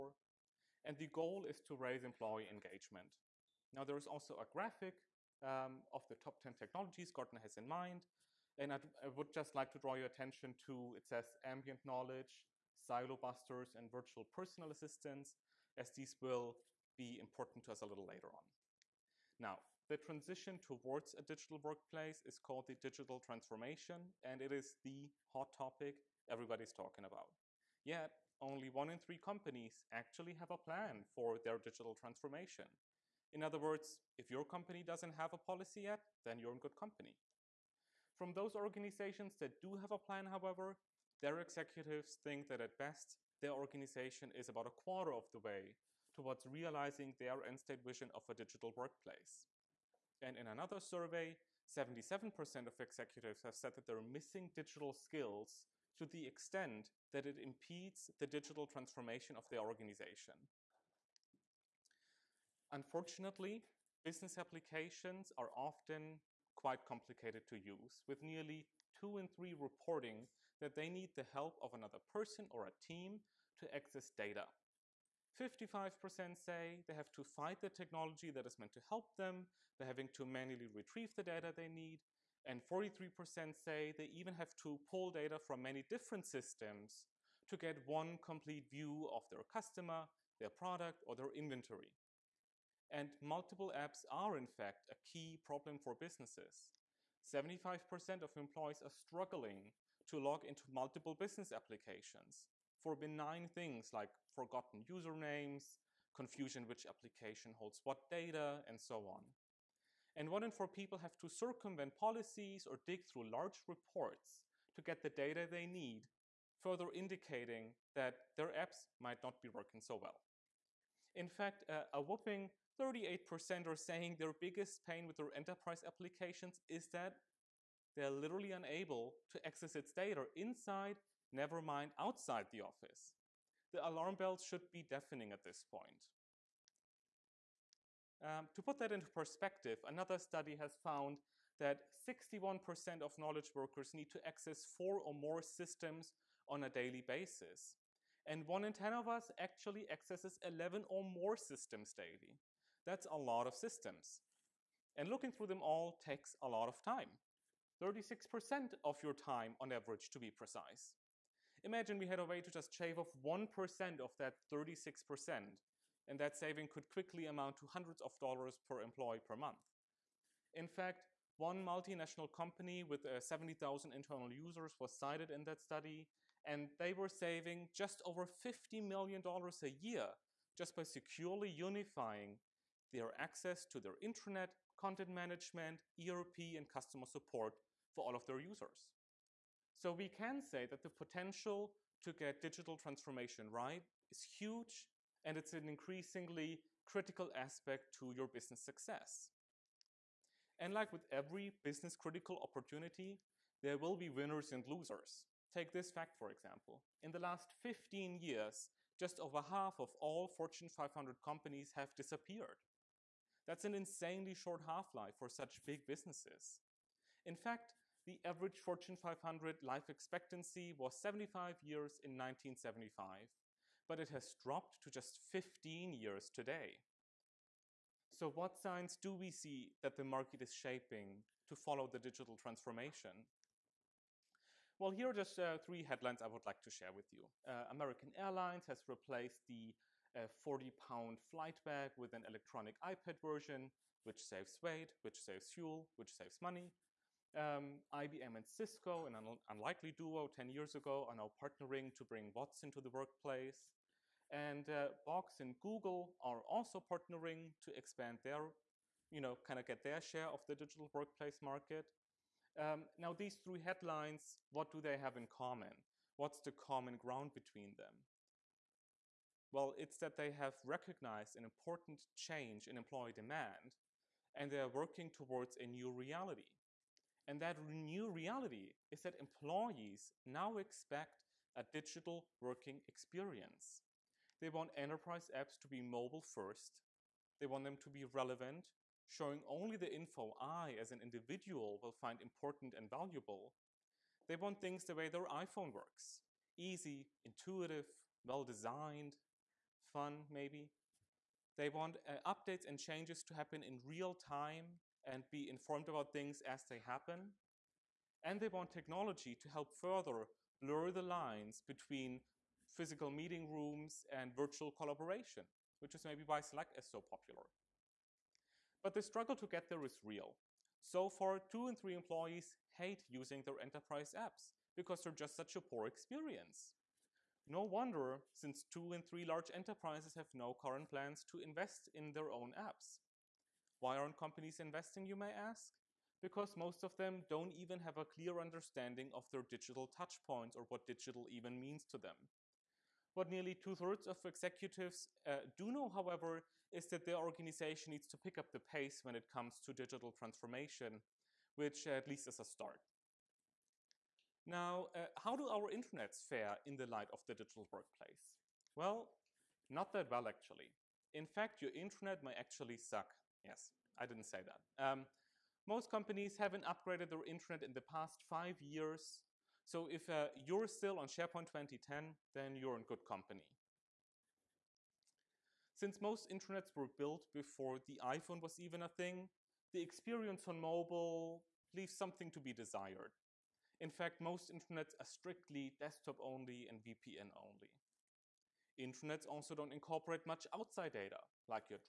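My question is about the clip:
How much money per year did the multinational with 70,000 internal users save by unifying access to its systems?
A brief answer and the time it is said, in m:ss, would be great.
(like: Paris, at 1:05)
Just over $50 million, at 2:57.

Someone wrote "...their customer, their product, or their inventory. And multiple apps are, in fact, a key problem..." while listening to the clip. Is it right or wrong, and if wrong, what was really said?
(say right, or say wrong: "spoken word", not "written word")
right.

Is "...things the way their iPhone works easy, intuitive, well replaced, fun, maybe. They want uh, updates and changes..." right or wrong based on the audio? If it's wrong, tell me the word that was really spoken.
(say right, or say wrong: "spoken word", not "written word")
wrong: "designed", not "replaced".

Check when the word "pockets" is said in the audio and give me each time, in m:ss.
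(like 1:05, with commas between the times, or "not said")
not said.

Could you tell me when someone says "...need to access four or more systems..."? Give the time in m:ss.
2:23.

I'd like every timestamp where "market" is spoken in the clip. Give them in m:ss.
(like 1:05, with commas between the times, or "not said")
3:50, 4:21.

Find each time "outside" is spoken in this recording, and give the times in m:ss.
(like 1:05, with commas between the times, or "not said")
2:11, 6:30.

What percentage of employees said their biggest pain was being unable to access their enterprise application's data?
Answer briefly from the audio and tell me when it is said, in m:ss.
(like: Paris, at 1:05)
38%, at 2:02.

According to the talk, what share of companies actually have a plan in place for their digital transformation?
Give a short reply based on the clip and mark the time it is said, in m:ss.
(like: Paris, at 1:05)
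1 in 3, at 0:28.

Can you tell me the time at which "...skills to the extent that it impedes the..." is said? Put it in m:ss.
0:54.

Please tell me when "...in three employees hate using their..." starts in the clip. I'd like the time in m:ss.
5:21.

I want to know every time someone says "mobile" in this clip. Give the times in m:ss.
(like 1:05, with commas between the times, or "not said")
4:45, 6:20.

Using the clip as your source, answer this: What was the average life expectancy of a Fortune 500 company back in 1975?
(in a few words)
75 years.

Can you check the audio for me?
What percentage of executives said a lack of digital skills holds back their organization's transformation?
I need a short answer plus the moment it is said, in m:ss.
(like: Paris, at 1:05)
77%, at 0:51.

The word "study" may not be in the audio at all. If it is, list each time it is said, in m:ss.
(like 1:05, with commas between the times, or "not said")
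2:20, 2:55.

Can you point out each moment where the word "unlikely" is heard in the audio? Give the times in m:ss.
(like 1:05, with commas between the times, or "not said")
4:09.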